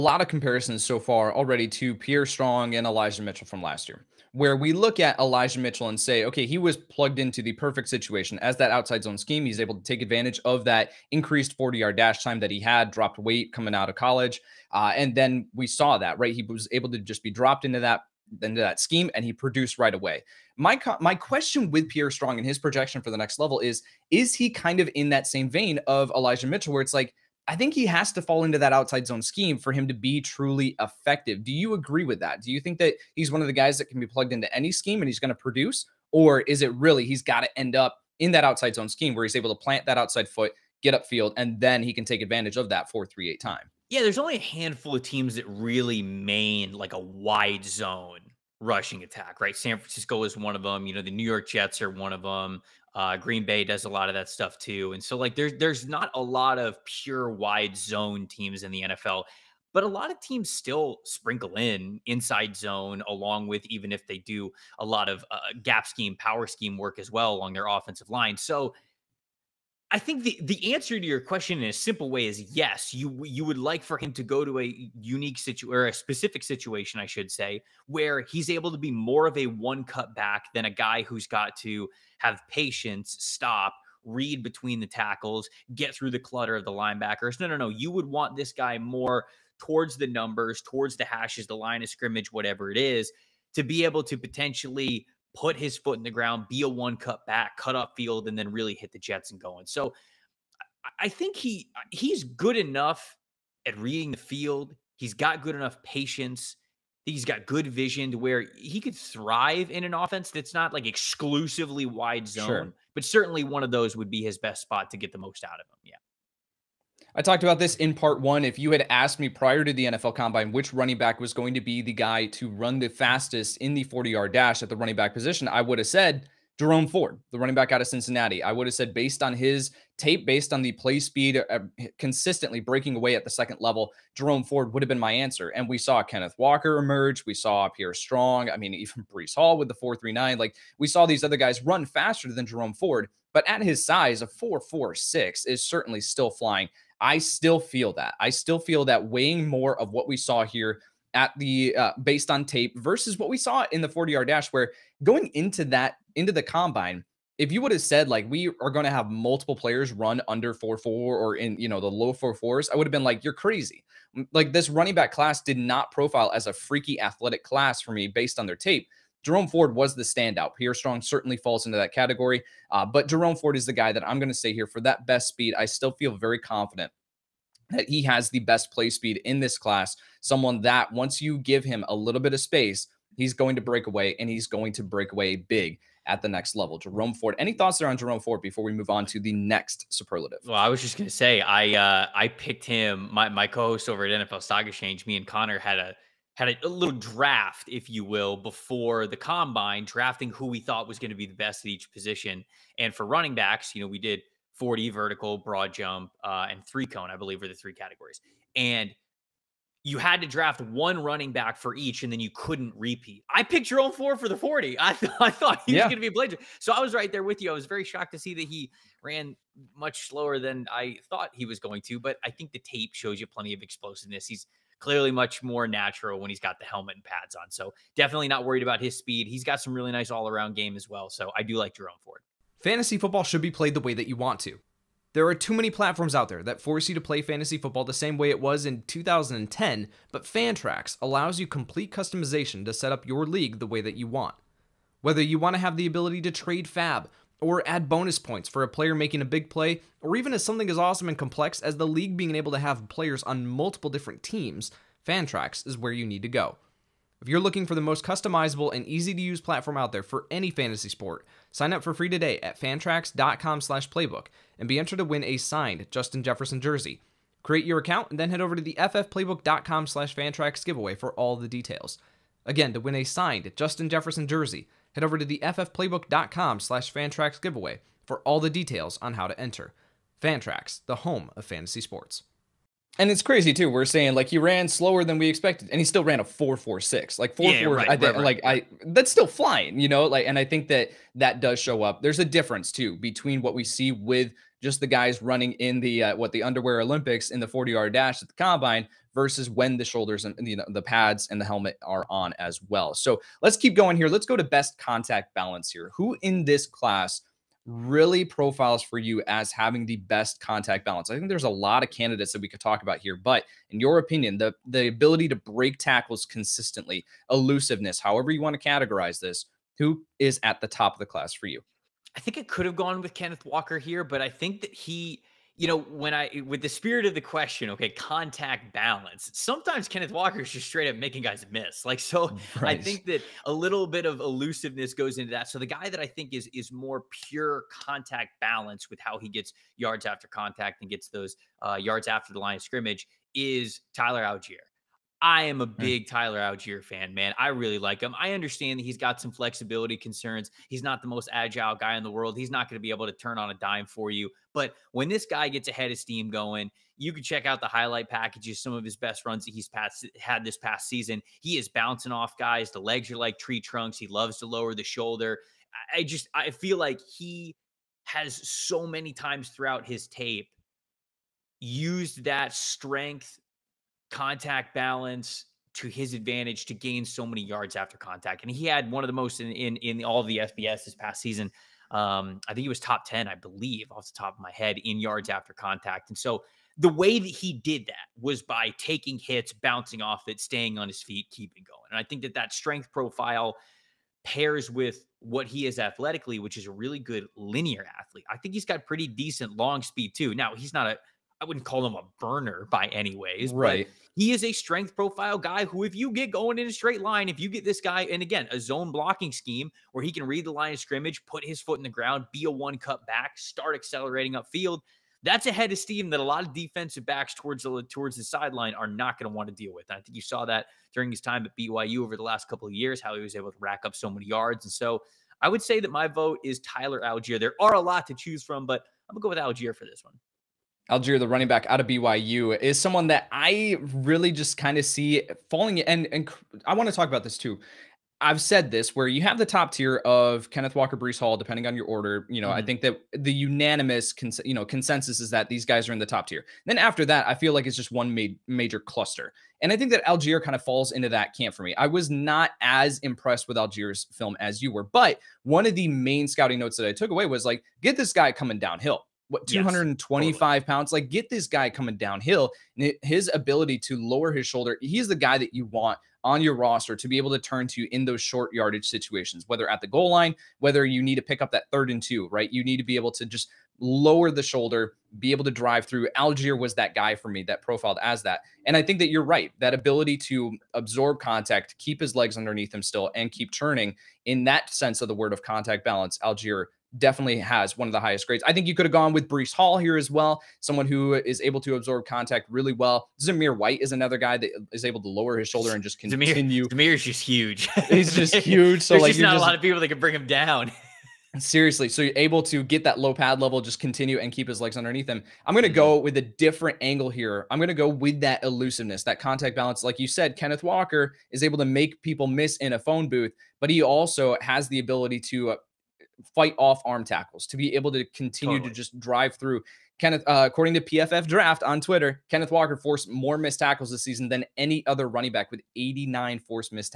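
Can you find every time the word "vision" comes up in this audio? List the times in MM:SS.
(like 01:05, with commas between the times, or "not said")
01:47.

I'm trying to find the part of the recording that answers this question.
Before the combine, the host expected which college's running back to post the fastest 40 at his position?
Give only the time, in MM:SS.
02:07.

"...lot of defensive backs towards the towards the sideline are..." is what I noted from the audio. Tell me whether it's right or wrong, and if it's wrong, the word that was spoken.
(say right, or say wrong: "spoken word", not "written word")
right.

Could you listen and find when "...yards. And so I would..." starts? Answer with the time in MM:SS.
07:04.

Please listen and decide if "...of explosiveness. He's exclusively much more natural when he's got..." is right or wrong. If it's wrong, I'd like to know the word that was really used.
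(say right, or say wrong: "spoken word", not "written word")
wrong: "clearly", not "exclusively".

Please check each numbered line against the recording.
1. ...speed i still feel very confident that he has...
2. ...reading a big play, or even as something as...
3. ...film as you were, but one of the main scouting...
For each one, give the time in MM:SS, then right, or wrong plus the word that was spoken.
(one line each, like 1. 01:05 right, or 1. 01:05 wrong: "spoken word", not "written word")
1. 02:55 right
2. 04:08 wrong: "making", not "reading"
3. 07:34 right.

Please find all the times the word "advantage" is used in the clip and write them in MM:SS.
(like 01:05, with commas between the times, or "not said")
00:10, 00:42, 06:16.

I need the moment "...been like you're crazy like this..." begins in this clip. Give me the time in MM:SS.
02:42.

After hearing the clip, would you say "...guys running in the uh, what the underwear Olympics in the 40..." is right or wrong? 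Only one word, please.
right.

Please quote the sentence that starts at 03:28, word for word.
And you had to draft one running back for each, and then you couldn't repeat.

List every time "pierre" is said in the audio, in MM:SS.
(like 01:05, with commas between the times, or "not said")
00:01, 00:21, 02:17, 02:50.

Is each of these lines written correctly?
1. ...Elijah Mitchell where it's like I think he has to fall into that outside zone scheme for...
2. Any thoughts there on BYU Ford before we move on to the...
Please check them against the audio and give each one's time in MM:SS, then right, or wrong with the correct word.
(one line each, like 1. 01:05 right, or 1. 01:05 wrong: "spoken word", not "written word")
1. 00:26 right
2. 03:07 wrong: "Jerome", not "BYU".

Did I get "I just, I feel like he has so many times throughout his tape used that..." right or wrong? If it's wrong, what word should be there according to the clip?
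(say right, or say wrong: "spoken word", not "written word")
right.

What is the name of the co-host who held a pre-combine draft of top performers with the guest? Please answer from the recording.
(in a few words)
Connor.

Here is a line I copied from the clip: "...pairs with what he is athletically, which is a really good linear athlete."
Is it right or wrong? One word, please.
right.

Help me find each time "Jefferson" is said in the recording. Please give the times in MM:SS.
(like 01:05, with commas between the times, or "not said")
04:26, 04:33.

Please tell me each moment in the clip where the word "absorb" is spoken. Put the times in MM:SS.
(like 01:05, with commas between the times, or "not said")
08:00, 08:11.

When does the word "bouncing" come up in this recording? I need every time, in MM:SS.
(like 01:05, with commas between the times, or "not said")
06:01, 06:29.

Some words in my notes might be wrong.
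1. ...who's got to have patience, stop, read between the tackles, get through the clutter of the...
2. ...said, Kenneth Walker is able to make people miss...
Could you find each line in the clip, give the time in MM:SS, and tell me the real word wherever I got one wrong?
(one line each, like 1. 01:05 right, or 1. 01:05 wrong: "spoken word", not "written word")
1. 01:21 right
2. 08:30 right.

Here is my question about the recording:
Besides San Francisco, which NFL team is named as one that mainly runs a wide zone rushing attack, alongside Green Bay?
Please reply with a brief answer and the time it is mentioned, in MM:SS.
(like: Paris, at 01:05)
New York Jets, at 00:51.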